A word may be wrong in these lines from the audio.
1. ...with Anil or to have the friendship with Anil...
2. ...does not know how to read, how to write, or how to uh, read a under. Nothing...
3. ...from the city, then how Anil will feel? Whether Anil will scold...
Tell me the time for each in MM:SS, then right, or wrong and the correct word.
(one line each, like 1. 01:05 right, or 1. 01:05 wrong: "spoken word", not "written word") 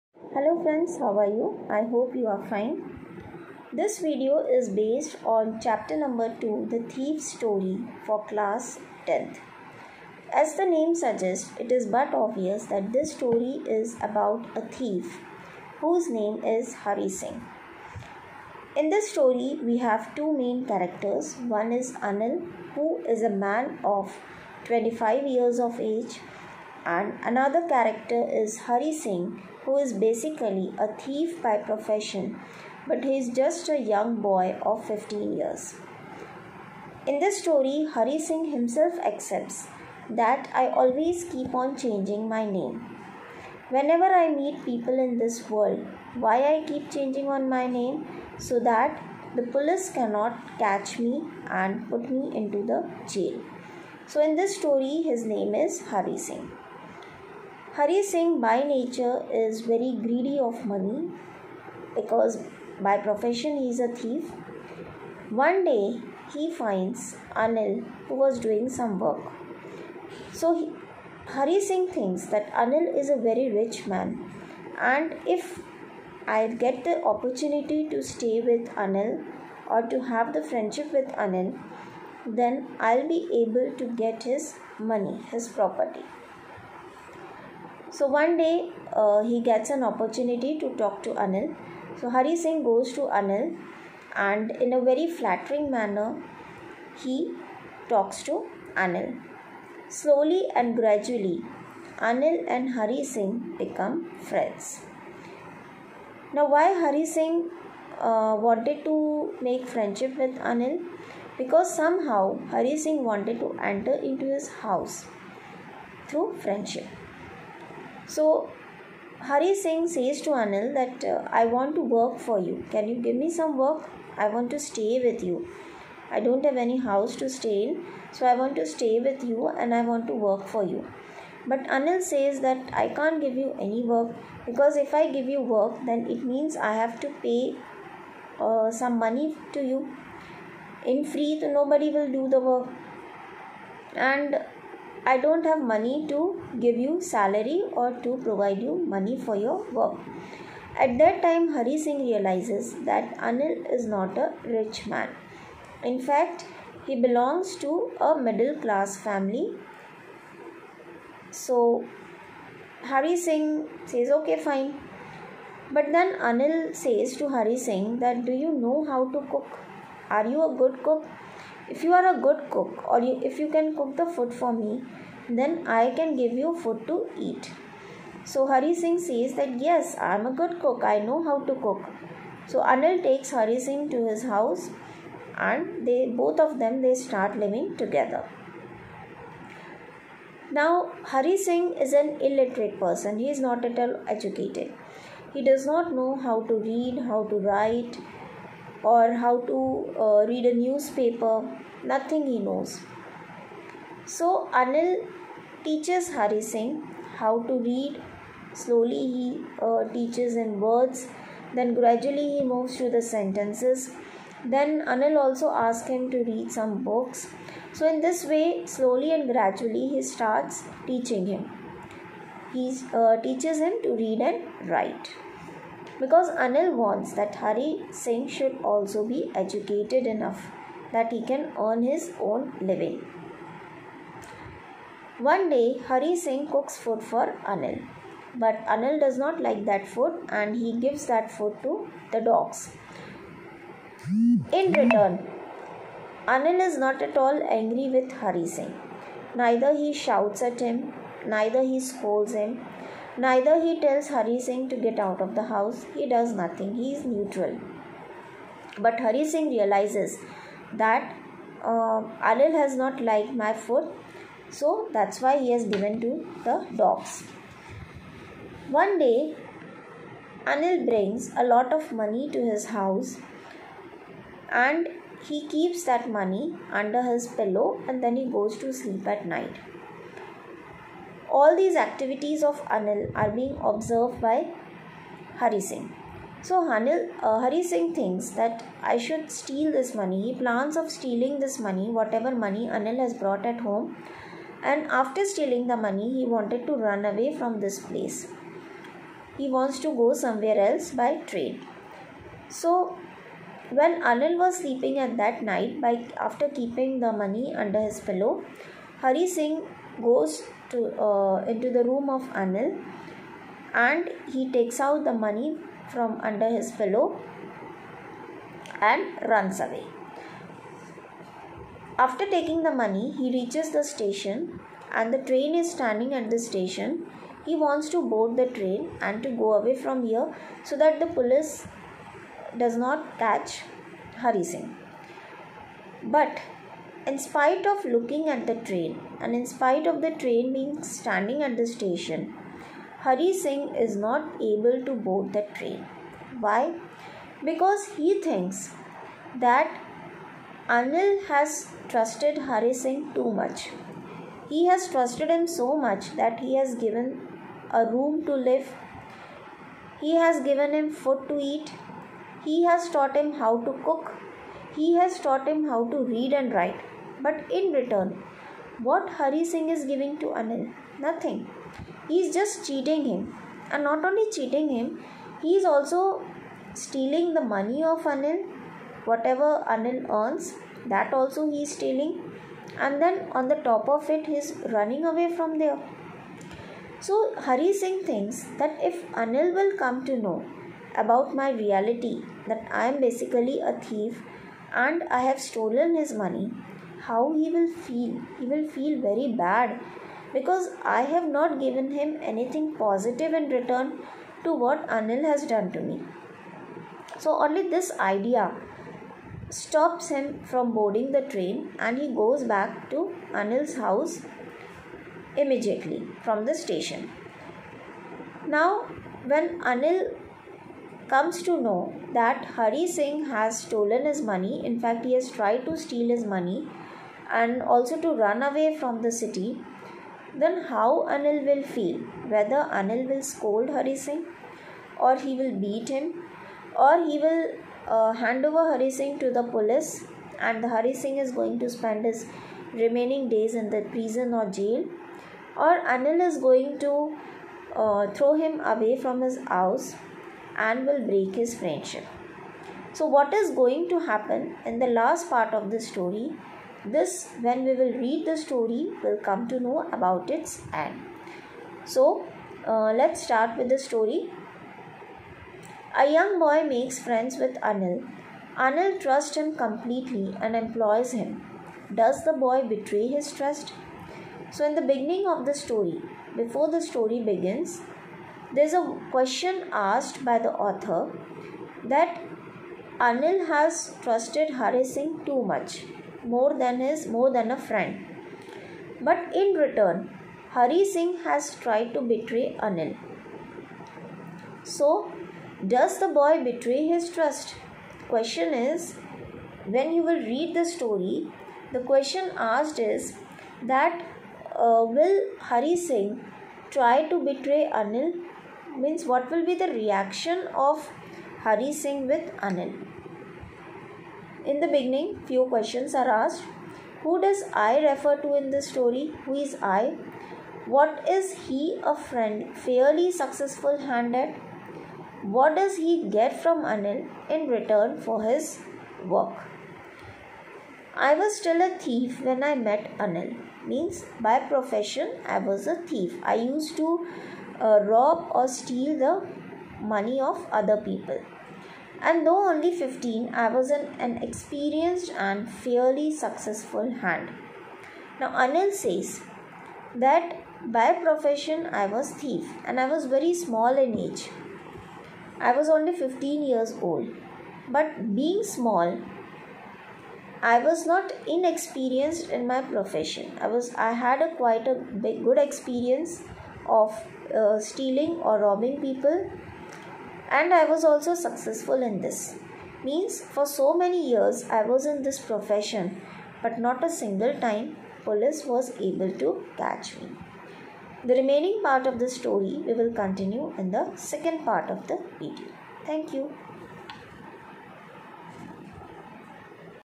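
1. 01:18 right
2. 03:15 wrong: "newspaper", not "under"
3. 07:08 right.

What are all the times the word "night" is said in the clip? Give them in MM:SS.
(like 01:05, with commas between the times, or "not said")
04:39, 05:05.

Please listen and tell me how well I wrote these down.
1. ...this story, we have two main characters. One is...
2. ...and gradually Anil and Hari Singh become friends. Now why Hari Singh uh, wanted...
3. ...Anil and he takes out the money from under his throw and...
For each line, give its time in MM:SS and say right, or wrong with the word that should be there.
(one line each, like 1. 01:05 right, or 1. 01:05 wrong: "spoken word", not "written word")
1. 00:18 right
2. 01:40 right
3. 05:12 wrong: "pillow", not "throw".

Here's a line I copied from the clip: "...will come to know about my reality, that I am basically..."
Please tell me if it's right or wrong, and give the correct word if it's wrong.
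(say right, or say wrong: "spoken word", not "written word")
right.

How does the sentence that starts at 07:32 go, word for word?
So, what is going to happen in the last part of the story?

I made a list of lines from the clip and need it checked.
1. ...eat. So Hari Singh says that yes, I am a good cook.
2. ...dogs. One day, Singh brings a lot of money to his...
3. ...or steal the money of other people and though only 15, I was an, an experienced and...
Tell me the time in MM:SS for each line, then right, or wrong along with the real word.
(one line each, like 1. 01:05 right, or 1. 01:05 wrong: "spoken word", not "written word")
1. 02:57 right
2. 04:26 wrong: "Anil", not "Singh"
3. 08:58 right.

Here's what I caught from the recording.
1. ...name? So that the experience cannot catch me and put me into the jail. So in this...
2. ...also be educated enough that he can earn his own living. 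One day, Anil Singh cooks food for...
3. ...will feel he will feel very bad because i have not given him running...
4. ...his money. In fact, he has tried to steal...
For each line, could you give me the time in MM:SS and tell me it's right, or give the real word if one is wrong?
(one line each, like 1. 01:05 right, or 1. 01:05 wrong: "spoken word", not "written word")
1. 00:47 wrong: "police", not "experience"
2. 03:48 wrong: "Hari", not "Anil"
3. 06:37 wrong: "anything", not "running"
4. 07:04 right.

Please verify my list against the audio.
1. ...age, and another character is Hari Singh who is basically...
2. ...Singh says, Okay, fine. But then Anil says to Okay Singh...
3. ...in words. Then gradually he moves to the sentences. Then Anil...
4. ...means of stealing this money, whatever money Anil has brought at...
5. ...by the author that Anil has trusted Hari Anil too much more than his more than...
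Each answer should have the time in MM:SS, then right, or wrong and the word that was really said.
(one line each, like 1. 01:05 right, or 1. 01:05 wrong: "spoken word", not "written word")
1. 00:25 right
2. 02:43 wrong: "Hari", not "Okay"
3. 03:30 right
4. 04:50 wrong: "plans", not "means"
5. 08:00 wrong: "Singh", not "Anil".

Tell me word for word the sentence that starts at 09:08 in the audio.
Now, Anil says that by profession I was thief and I was very small in age.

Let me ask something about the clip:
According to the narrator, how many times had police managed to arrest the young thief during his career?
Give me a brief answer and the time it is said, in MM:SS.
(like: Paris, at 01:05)
Not a single time, at 09:36.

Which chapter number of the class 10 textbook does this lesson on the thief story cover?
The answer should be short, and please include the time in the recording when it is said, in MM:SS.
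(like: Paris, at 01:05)
2, at 00:05.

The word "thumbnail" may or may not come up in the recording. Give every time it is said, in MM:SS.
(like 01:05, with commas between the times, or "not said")
not said.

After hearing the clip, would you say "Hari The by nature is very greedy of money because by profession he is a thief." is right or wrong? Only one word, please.
wrong.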